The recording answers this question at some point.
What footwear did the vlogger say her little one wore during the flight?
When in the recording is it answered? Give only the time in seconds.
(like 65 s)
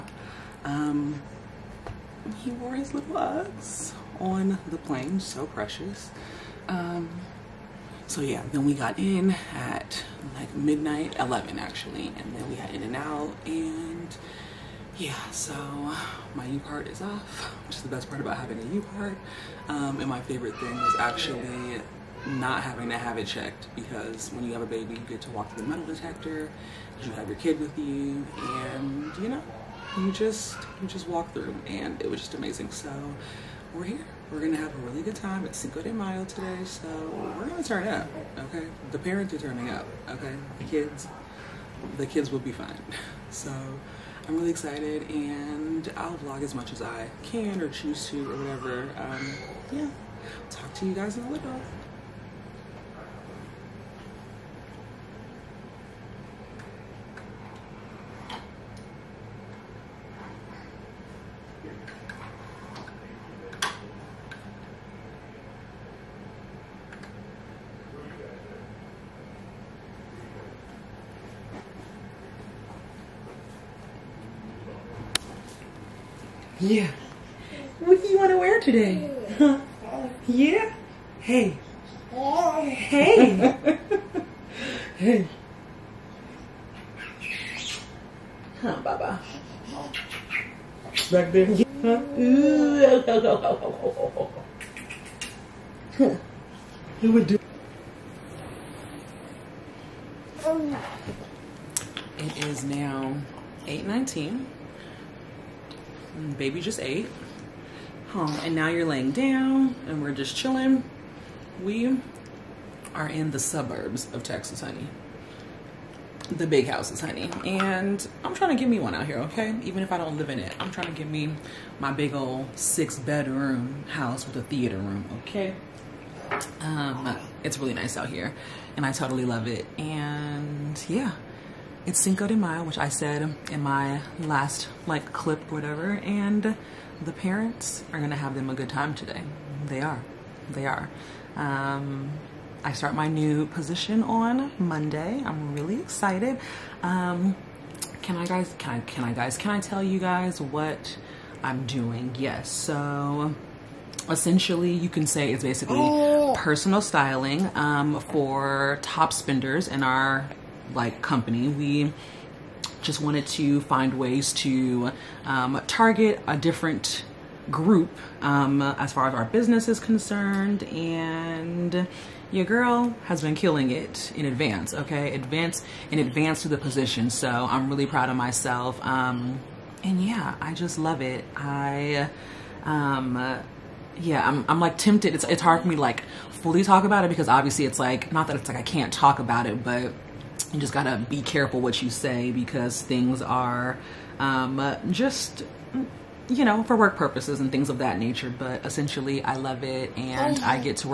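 3 s.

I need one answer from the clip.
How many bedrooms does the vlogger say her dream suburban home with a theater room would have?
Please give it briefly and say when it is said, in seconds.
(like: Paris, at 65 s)
6, at 122 s.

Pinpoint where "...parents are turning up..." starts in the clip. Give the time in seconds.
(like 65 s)
38 s.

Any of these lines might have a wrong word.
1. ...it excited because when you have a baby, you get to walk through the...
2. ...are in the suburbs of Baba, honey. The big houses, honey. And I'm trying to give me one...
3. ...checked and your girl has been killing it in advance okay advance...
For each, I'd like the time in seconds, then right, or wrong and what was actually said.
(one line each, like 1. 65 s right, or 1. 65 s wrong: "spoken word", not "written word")
1. 23 s wrong: "checked", not "excited"
2. 112 s wrong: "Texas", not "Baba"
3. 169 s wrong: "concerned", not "checked".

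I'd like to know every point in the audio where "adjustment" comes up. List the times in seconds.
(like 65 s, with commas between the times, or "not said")
not said.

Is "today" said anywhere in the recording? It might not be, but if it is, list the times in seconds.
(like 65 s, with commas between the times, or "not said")
36 s, 78 s, 138 s.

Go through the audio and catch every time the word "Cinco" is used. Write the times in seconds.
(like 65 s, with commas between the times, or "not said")
35 s, 131 s.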